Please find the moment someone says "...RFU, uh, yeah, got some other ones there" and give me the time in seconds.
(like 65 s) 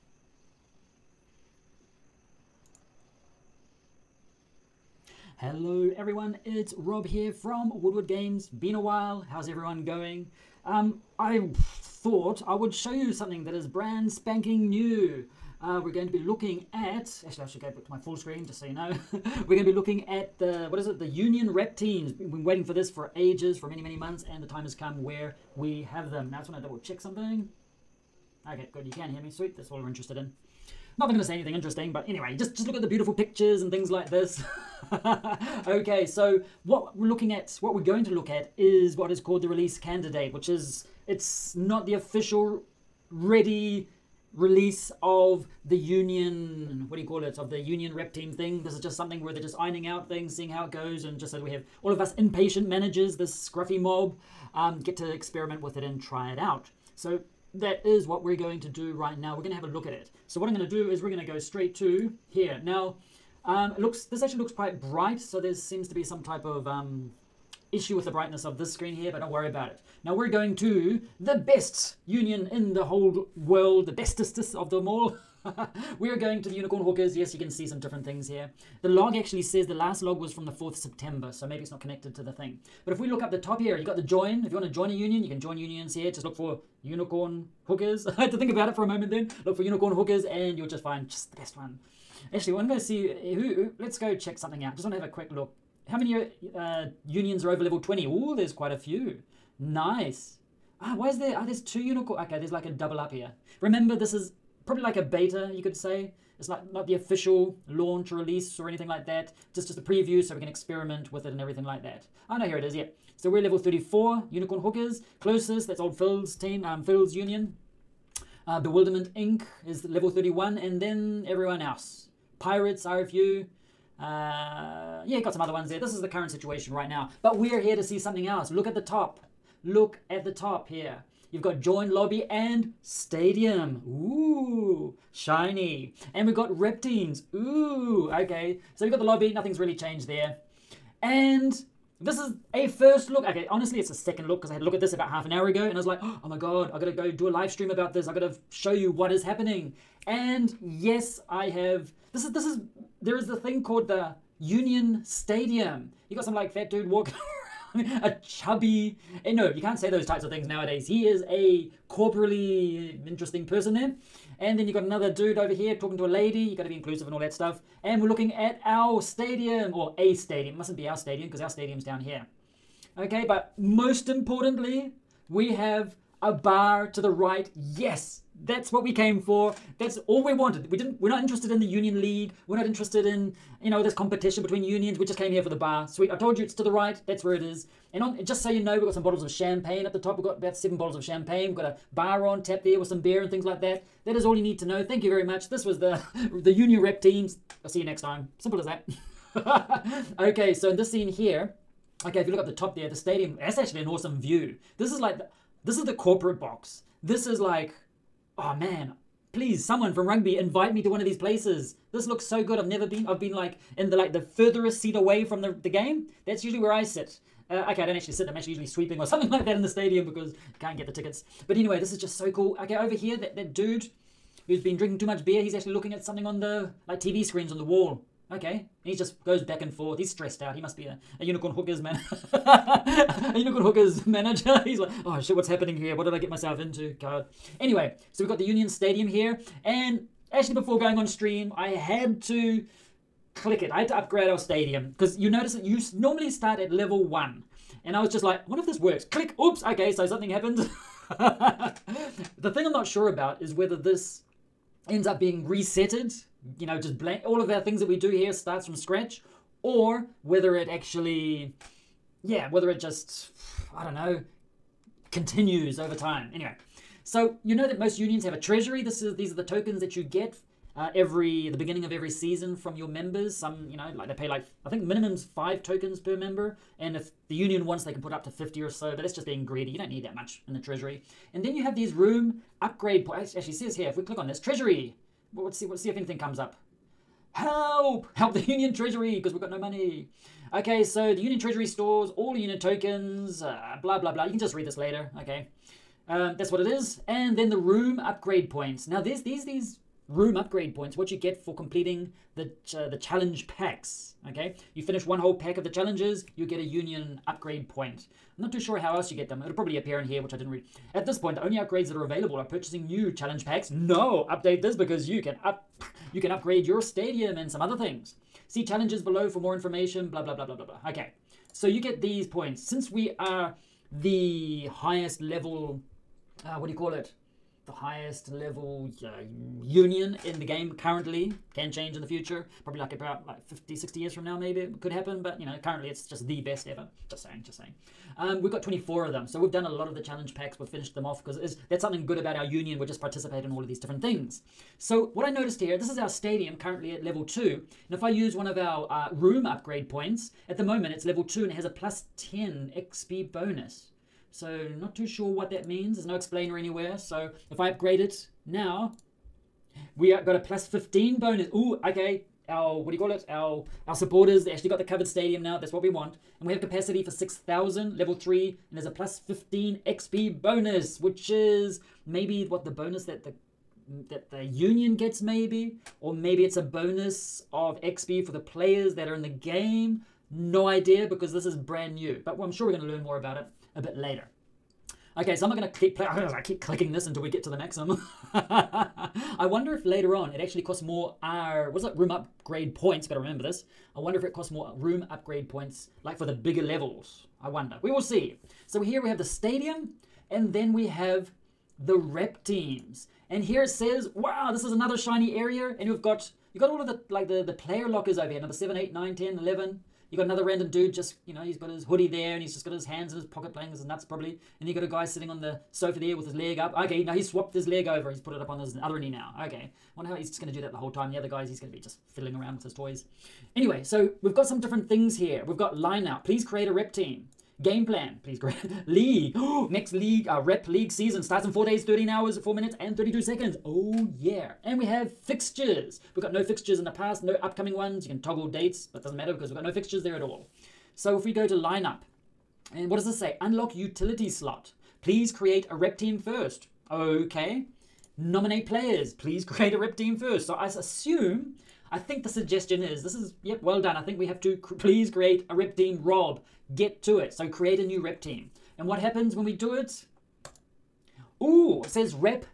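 122 s.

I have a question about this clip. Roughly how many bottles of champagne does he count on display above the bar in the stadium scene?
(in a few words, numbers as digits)
7.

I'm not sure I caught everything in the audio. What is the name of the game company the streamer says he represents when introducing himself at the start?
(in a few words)
Woodward Games.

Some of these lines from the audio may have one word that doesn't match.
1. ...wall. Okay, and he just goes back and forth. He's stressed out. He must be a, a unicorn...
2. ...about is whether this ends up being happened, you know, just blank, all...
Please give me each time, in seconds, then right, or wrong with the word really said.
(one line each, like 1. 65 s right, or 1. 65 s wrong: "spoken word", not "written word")
1. 227 s right
2. 253 s wrong: "resetted", not "happened".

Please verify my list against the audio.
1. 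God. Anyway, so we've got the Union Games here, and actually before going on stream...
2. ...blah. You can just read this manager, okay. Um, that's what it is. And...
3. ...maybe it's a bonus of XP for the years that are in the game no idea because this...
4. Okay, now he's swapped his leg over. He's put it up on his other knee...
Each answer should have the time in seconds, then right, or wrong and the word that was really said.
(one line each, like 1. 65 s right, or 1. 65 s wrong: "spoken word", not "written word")
1. 236 s wrong: "Stadium", not "Games"
2. 294 s wrong: "later", not "manager"
3. 376 s wrong: "players", not "years"
4. 416 s right.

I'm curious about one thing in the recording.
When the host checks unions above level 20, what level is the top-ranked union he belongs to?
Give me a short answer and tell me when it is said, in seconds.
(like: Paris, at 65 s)
34, at 113 s.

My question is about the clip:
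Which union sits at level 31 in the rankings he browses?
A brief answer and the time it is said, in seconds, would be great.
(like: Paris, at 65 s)
Bewilderment Inc., at 118 s.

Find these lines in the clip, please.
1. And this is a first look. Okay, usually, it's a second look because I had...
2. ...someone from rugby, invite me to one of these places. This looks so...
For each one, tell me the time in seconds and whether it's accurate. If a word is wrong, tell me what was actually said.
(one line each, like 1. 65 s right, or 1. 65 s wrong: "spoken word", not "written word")
1. 141 s wrong: "honestly", not "usually"
2. 209 s right.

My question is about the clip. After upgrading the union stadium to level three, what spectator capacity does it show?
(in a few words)
6,000.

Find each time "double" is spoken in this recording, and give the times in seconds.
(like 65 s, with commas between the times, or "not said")
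26 s, 102 s.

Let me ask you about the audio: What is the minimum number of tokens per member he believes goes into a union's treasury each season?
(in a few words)
5.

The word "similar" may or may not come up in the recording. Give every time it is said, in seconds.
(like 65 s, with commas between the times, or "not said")
not said.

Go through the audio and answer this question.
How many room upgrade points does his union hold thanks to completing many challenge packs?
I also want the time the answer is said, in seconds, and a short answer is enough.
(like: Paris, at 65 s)
24, at 338 s.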